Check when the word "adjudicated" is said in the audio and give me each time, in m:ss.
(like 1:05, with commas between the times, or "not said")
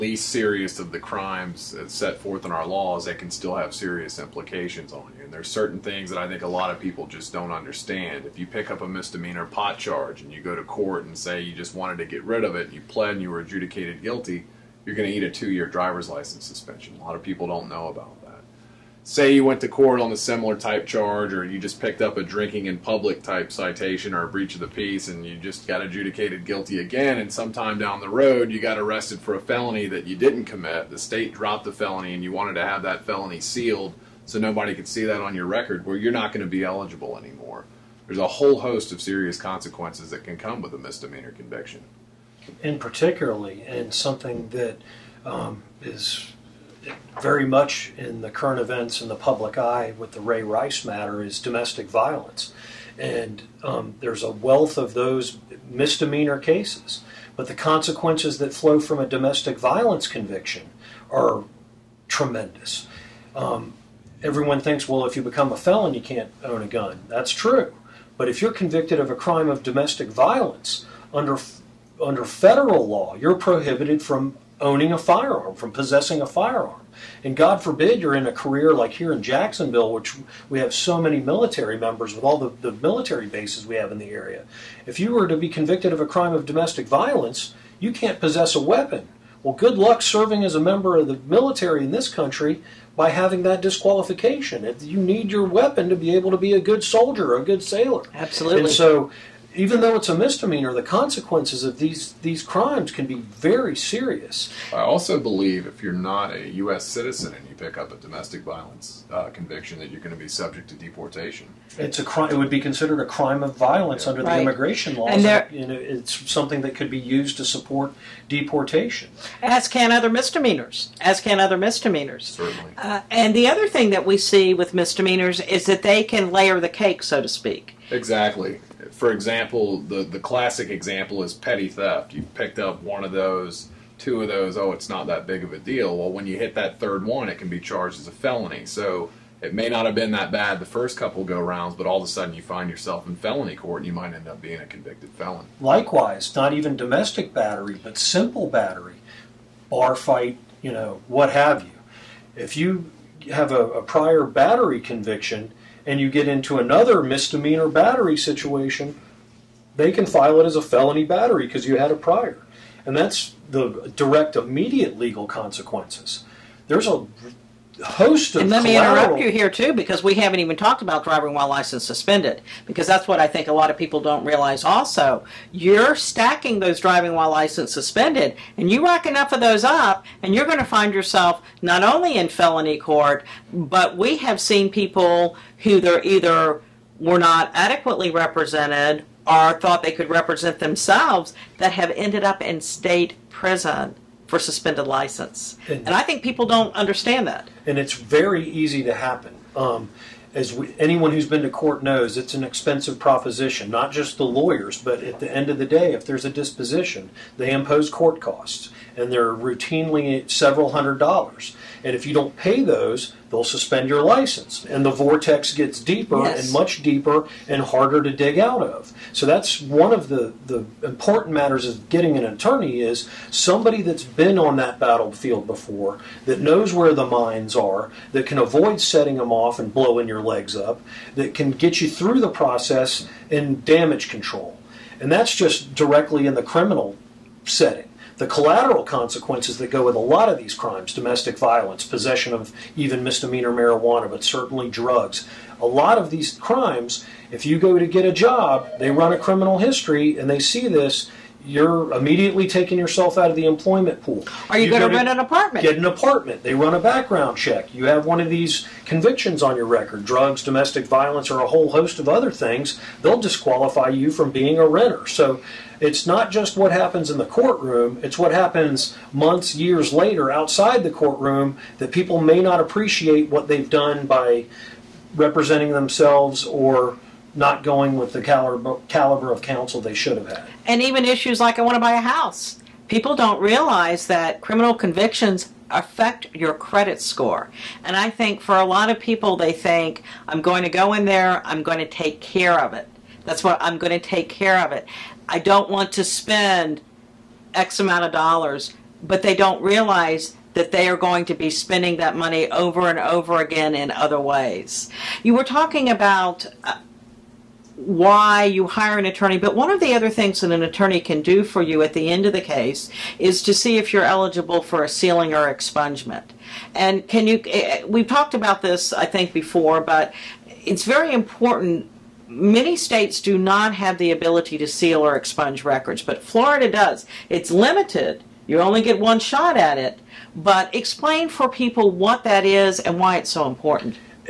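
0:13, 0:25.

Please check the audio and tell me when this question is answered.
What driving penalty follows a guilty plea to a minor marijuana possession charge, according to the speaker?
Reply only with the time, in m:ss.
0:15.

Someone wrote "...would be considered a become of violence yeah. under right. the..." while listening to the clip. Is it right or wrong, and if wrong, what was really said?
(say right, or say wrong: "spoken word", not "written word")
wrong: "crime", not "become".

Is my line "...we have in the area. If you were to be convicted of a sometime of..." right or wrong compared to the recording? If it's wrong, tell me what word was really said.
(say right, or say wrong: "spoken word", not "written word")
wrong: "crime", not "sometime".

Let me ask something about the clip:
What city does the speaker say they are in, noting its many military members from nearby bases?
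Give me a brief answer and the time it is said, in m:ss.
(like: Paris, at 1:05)
Jacksonville, at 1:19.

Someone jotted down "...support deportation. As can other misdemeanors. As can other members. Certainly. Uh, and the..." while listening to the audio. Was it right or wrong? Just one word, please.
wrong.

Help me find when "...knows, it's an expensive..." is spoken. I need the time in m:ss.
3:21.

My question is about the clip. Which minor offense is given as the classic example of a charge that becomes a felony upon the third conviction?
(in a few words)
Petty theft.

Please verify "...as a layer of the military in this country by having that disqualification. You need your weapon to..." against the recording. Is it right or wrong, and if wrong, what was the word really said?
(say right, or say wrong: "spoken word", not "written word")
wrong: "member", not "layer".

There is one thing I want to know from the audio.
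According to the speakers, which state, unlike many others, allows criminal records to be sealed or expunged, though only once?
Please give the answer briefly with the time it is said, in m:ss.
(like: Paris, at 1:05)
Florida, at 5:26.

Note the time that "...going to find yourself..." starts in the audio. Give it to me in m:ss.
3:00.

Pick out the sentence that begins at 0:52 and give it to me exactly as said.
And um, there's a wealth of those misdemeanor cases.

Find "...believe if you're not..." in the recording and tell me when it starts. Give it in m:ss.
1:45.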